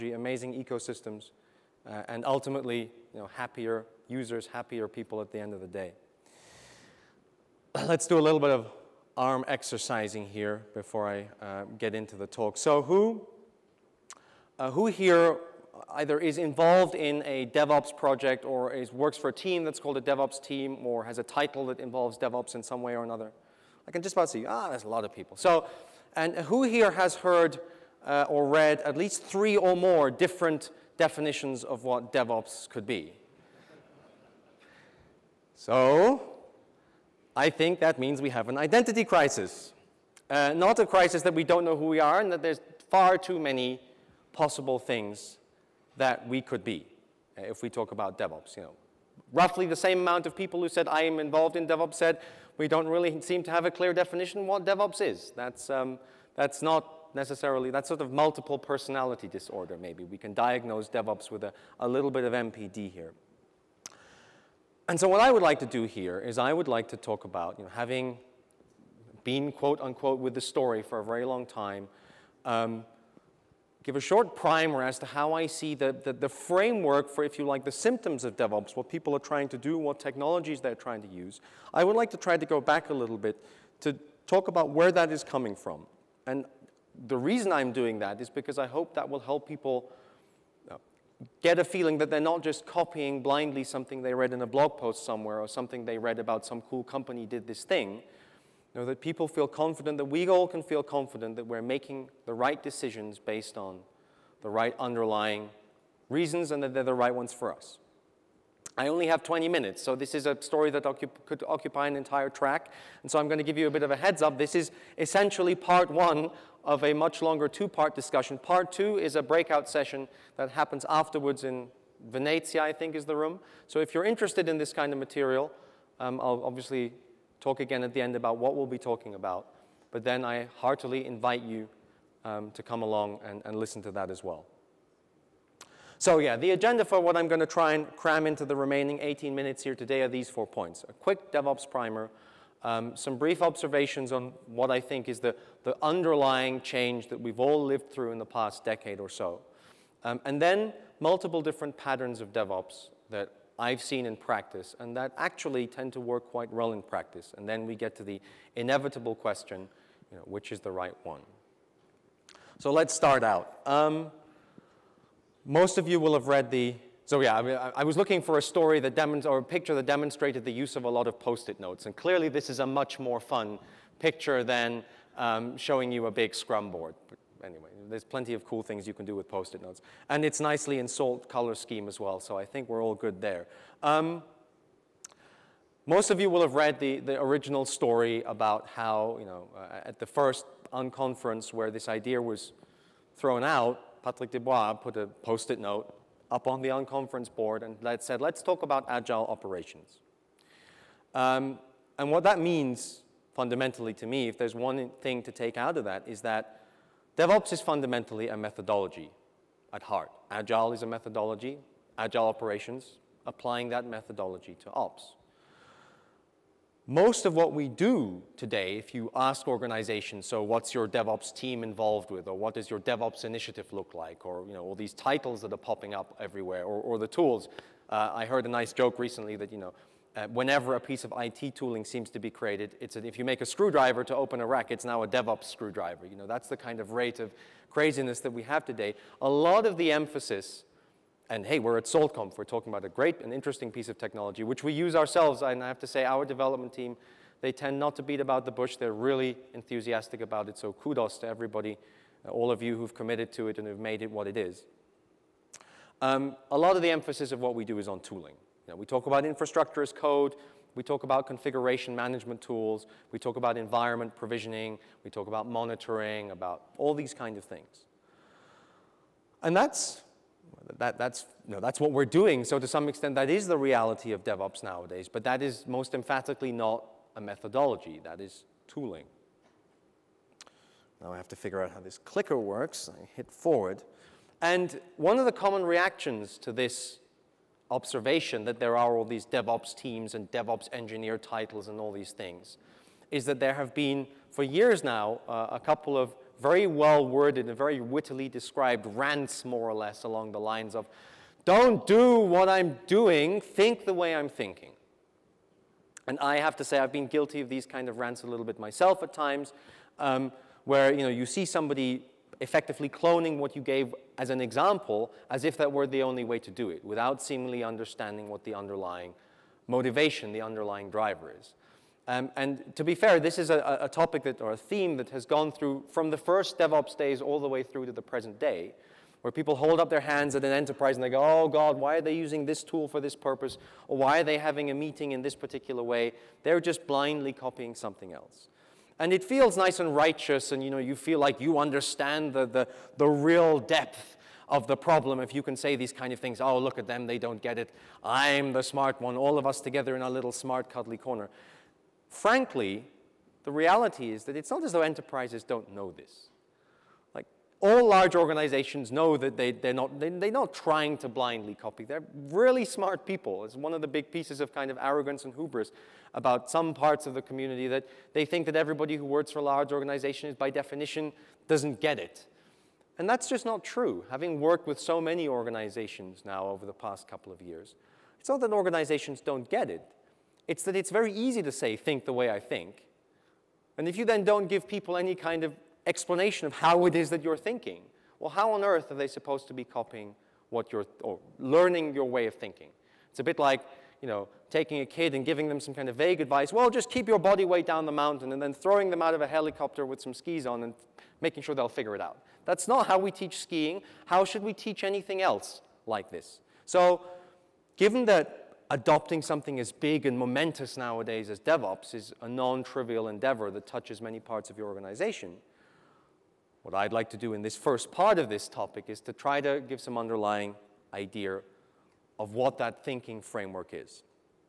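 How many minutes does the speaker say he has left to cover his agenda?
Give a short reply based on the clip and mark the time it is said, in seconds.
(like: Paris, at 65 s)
18, at 139 s.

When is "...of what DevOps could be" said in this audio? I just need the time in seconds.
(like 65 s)
31 s.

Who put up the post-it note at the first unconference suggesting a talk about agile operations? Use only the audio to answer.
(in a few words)
Patrick Debois.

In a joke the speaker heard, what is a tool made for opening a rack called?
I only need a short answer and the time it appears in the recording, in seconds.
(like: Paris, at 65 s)
DevOps screwdriver, at 235 s.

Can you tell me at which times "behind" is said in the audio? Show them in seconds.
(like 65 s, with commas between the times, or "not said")
not said.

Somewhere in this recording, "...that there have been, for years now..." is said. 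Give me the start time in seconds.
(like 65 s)
293 s.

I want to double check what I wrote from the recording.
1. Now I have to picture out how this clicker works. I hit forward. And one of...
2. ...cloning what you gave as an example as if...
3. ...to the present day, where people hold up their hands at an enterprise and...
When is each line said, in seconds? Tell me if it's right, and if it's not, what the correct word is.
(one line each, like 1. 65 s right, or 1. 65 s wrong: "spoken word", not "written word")
1. 281 s wrong: "figure", not "picture"
2. 312 s right
3. 327 s right.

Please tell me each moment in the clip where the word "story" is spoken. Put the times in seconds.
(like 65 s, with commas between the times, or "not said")
70 s, 110 s, 168 s, 187 s.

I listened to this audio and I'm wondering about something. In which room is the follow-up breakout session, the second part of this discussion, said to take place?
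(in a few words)
Venezia.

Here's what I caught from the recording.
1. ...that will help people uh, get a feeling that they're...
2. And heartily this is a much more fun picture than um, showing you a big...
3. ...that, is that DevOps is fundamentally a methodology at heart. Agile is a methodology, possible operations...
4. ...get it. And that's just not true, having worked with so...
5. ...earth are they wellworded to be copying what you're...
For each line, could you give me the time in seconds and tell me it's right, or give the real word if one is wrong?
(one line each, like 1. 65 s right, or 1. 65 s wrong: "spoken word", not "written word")
1. 88 s right
2. 171 s wrong: "clearly", not "heartily"
3. 205 s wrong: "agile", not "possible"
4. 371 s right
5. 388 s wrong: "supposed", not "wellworded".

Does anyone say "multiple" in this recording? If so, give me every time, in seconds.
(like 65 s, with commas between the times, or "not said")
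58 s, 151 s.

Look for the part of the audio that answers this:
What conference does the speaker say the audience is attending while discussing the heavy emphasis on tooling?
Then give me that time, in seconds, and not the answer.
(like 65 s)
241 s.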